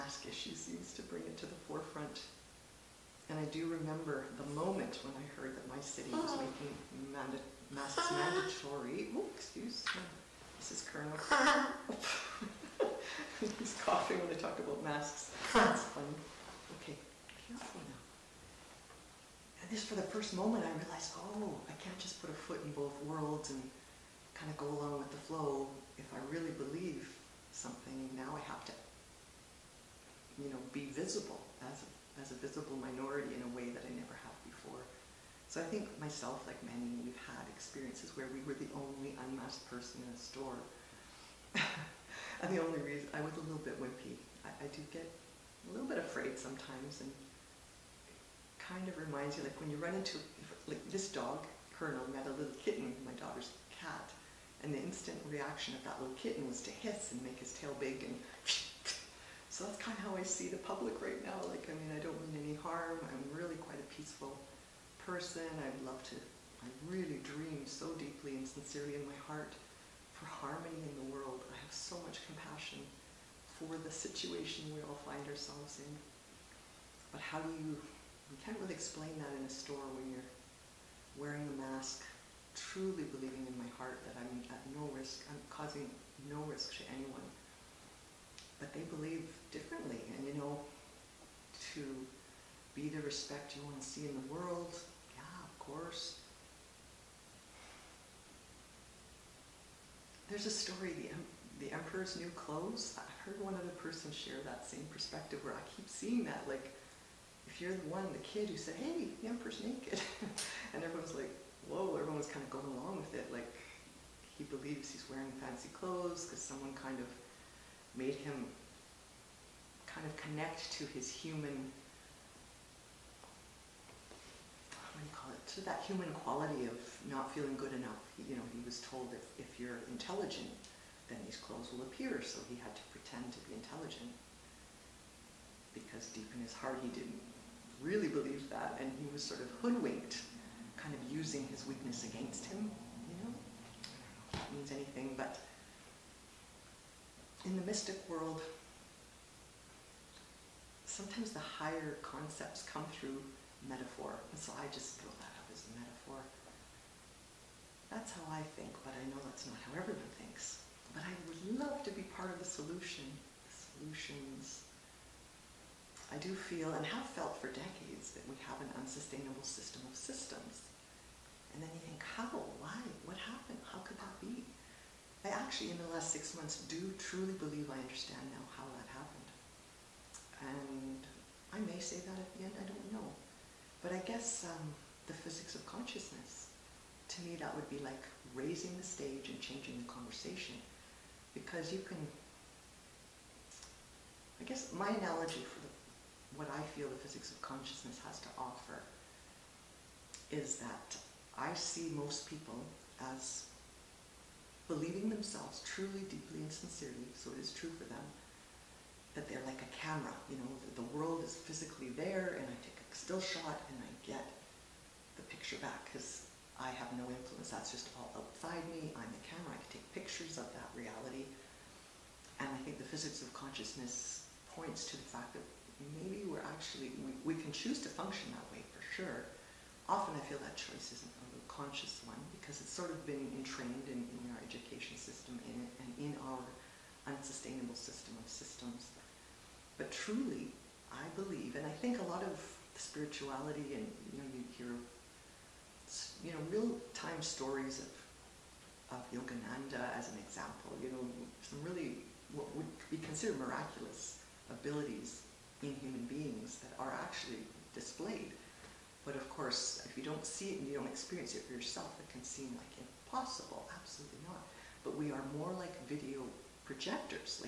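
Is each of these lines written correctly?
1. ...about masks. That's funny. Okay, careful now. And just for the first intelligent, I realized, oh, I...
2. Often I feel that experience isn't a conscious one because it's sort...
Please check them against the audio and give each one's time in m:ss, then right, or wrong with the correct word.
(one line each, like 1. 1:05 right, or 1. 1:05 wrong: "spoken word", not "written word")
1. 0:14 wrong: "moment", not "intelligent"
2. 3:49 wrong: "choice", not "experience".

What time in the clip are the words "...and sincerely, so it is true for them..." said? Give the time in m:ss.
3:26.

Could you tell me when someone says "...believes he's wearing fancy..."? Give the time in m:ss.
1:54.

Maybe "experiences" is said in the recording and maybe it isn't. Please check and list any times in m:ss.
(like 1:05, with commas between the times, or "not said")
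0:37, 4:20.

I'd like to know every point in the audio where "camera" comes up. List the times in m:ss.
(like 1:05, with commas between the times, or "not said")
3:29, 3:39.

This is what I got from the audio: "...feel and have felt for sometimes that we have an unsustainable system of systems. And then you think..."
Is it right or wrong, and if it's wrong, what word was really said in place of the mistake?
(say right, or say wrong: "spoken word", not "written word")
wrong: "decades", not "sometimes".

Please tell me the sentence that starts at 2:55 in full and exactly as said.
I actually, in the last six months, do truly believe I understand now how that happened.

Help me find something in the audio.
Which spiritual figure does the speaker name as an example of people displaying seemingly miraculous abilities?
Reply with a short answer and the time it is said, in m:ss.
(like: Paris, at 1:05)
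Yogananda, at 4:09.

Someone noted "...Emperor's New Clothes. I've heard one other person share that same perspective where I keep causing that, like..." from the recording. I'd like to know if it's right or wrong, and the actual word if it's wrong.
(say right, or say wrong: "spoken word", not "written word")
wrong: "seeing", not "causing".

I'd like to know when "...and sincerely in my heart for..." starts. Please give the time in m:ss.
1:08.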